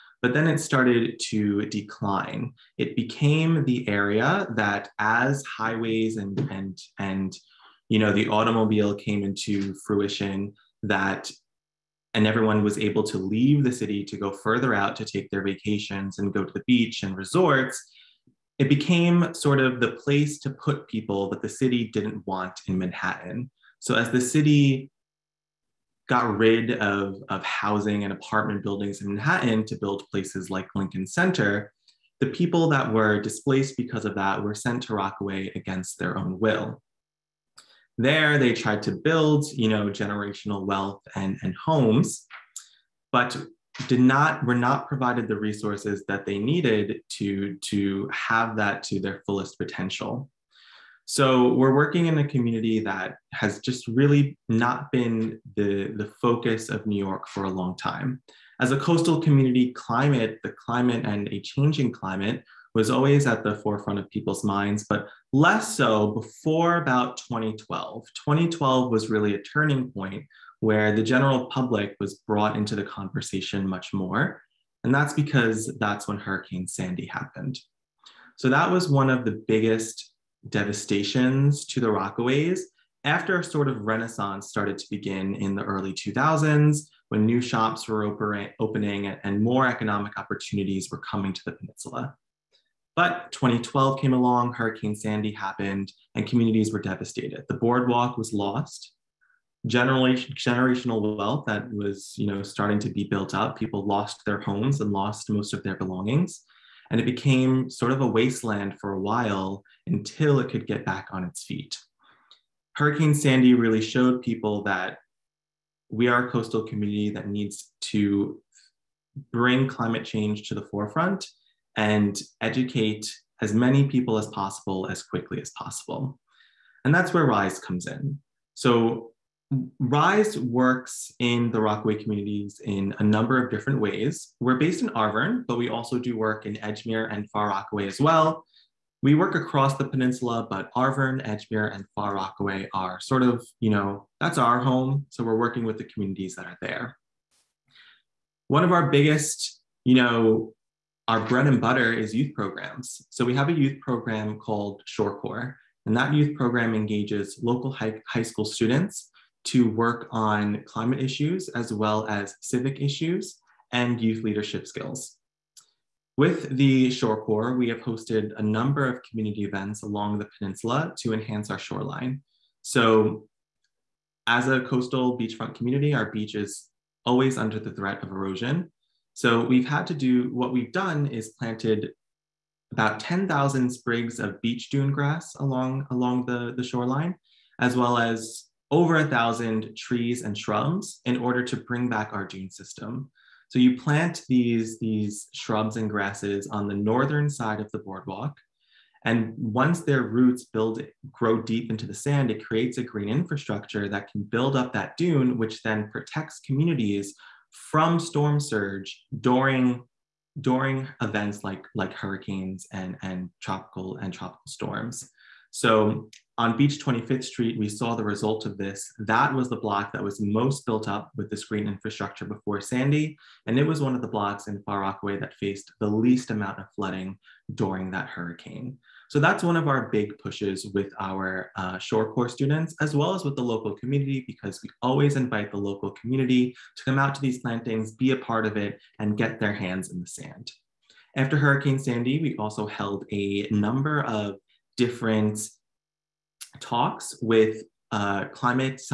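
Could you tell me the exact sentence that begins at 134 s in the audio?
We're based in Arverne, but we also do work in Edgemere and Far Rockaway as well.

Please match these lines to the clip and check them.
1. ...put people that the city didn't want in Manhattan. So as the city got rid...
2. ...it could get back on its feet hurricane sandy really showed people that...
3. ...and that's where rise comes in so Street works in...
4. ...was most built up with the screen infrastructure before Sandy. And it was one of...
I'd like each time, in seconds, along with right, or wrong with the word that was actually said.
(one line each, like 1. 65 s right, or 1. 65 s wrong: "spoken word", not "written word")
1. 20 s right
2. 110 s right
3. 126 s wrong: "Rise", not "Street"
4. 220 s right.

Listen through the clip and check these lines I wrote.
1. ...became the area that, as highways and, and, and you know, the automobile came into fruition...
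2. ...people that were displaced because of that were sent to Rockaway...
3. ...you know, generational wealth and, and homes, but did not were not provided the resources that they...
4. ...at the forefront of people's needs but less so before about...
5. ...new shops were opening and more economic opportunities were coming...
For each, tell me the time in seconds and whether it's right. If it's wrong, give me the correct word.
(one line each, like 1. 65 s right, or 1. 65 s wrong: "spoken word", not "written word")
1. 2 s right
2. 32 s right
3. 39 s right
4. 63 s wrong: "minds", not "needs"
5. 87 s right.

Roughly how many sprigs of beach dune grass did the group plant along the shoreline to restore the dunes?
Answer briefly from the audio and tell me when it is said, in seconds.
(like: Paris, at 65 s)
10,000, at 183 s.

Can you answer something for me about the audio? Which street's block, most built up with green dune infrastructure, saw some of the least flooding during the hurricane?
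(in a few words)
Beach 25th Street.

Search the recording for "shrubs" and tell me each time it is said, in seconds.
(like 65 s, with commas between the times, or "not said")
190 s, 195 s.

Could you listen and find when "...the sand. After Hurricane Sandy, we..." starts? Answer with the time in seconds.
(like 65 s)
240 s.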